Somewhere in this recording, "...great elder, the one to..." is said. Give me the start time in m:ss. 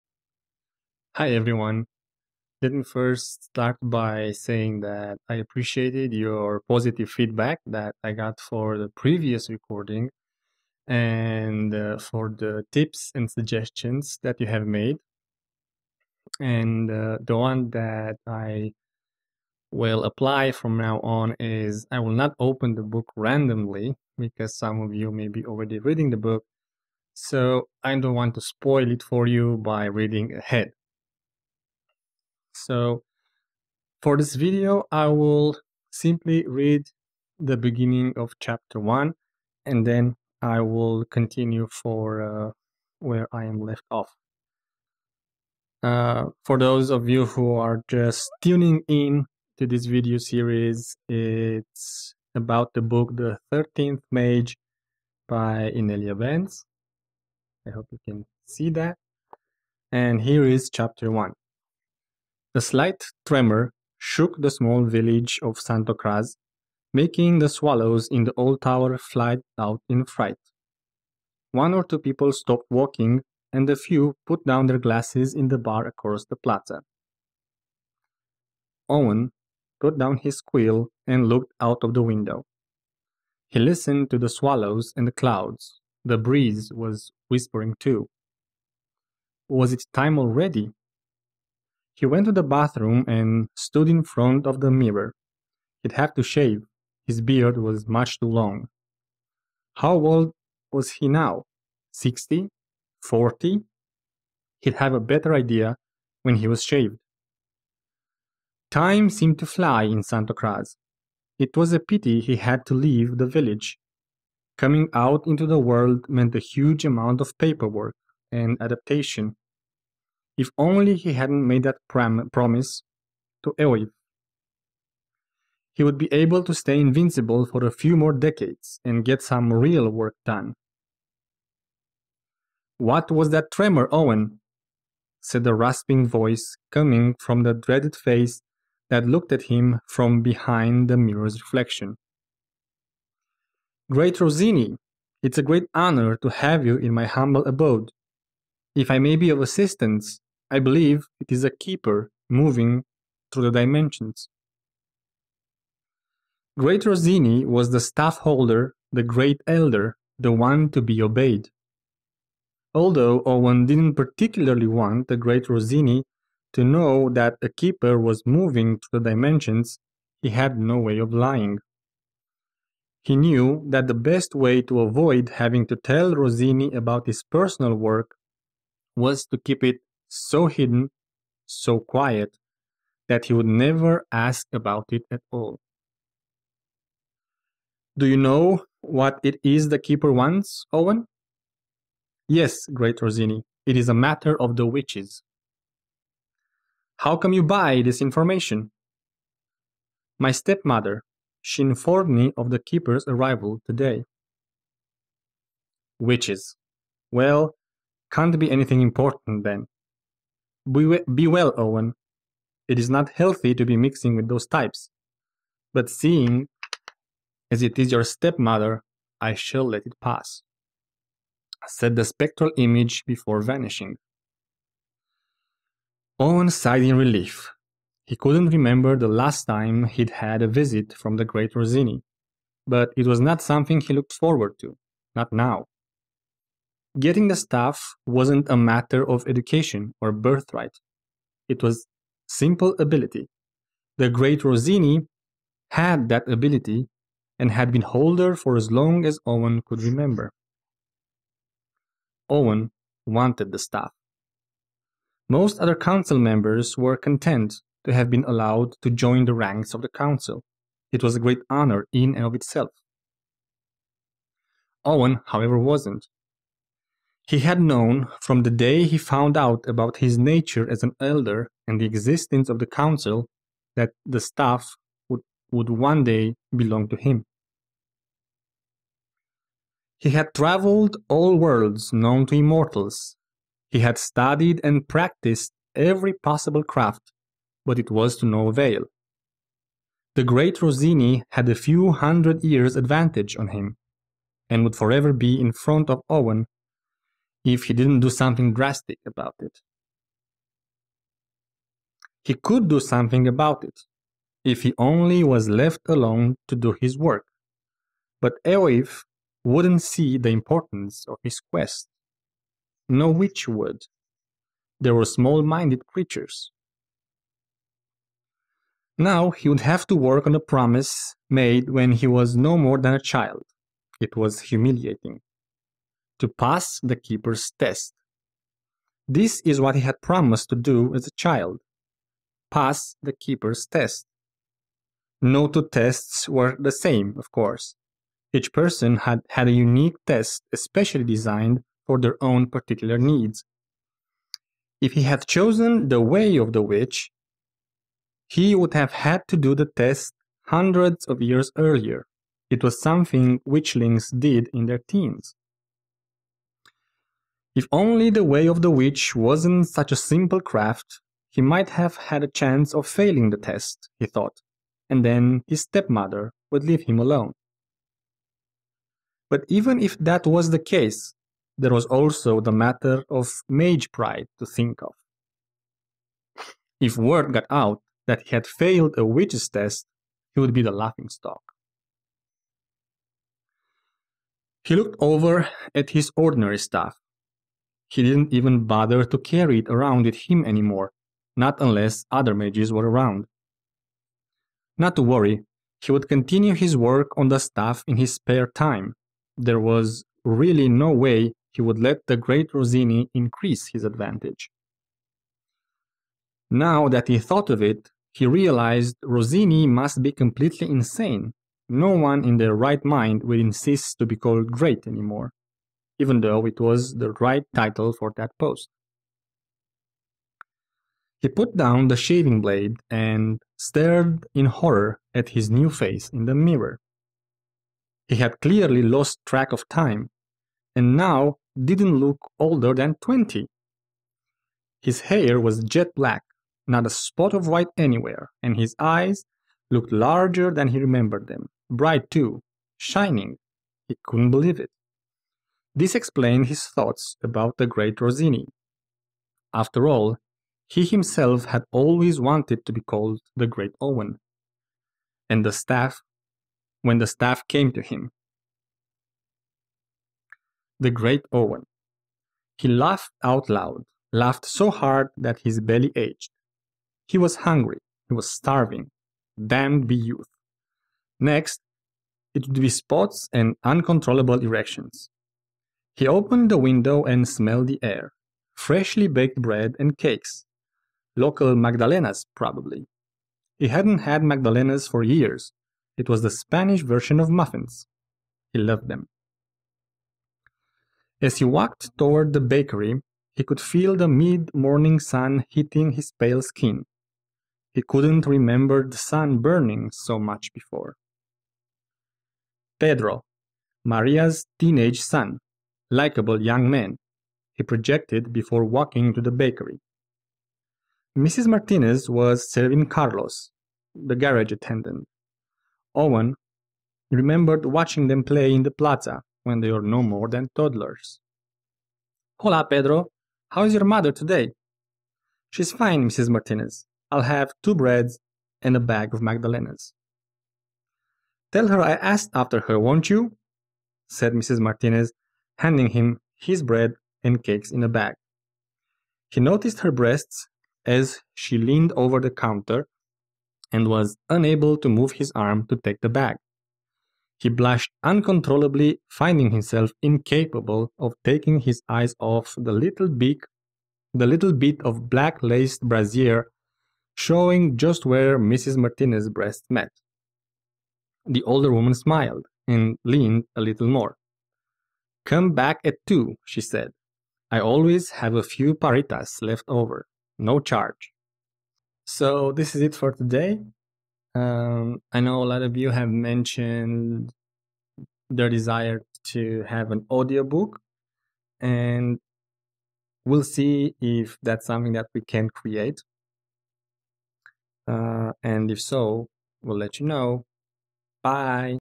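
2:39.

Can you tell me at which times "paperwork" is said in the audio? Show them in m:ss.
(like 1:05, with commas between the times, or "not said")
1:57.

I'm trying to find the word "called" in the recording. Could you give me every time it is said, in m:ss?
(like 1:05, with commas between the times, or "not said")
6:54, 7:32.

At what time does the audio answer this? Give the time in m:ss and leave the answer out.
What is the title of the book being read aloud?
0:53.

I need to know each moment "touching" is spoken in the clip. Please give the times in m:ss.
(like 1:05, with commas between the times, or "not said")
not said.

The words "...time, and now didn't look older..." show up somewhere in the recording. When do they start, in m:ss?
7:09.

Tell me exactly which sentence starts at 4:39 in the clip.
He had traveled all worlds known to immortals.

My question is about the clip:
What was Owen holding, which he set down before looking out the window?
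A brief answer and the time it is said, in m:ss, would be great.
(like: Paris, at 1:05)
His quill, at 1:20.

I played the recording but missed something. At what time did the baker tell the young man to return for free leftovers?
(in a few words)
2.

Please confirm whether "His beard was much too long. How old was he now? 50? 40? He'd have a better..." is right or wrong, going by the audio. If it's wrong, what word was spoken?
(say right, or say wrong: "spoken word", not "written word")
wrong: "60", not "50".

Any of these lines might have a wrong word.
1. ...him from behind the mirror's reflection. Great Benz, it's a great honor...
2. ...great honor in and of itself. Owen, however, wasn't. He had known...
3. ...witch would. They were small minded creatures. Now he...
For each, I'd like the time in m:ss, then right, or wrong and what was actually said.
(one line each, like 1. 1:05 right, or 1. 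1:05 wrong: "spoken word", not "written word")
1. 2:19 wrong: "Rosini", not "Benz"
2. 4:21 right
3. 5:13 right.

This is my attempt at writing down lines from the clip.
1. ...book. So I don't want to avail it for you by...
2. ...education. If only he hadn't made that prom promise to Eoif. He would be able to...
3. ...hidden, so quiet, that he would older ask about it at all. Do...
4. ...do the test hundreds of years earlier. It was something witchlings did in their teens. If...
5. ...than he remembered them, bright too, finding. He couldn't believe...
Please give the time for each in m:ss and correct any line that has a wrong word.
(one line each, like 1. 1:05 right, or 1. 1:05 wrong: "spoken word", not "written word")
1. 0:26 wrong: "spoil", not "avail"
2. 1:58 wrong: "adaptation", not "education"
3. 3:00 wrong: "never", not "older"
4. 5:49 right
5. 7:20 wrong: "shining", not "finding".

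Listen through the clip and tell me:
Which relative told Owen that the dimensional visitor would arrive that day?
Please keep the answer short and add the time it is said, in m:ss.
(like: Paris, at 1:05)
His stepmother, at 3:20.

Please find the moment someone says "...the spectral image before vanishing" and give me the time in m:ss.
3:41.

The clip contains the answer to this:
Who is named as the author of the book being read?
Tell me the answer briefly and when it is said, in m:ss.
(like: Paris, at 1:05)
Inelia Benz, at 0:55.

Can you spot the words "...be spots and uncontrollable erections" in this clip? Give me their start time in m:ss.
7:52.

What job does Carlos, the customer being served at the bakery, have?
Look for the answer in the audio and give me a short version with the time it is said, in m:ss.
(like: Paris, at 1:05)
Garage attendant, at 8:34.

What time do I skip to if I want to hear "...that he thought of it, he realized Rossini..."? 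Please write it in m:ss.
6:46.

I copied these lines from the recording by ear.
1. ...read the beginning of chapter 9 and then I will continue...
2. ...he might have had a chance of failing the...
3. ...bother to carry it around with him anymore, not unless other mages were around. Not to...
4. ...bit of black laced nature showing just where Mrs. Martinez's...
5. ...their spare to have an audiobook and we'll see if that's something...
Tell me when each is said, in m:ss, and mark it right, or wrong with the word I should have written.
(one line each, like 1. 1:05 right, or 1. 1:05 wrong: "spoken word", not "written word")
1. 0:36 wrong: "1", not "9"
2. 6:01 right
3. 6:28 right
4. 9:14 wrong: "brassiere", not "nature"
5. 9:38 wrong: "desire", not "spare".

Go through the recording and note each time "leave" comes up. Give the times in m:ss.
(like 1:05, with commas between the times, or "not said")
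1:52, 6:06.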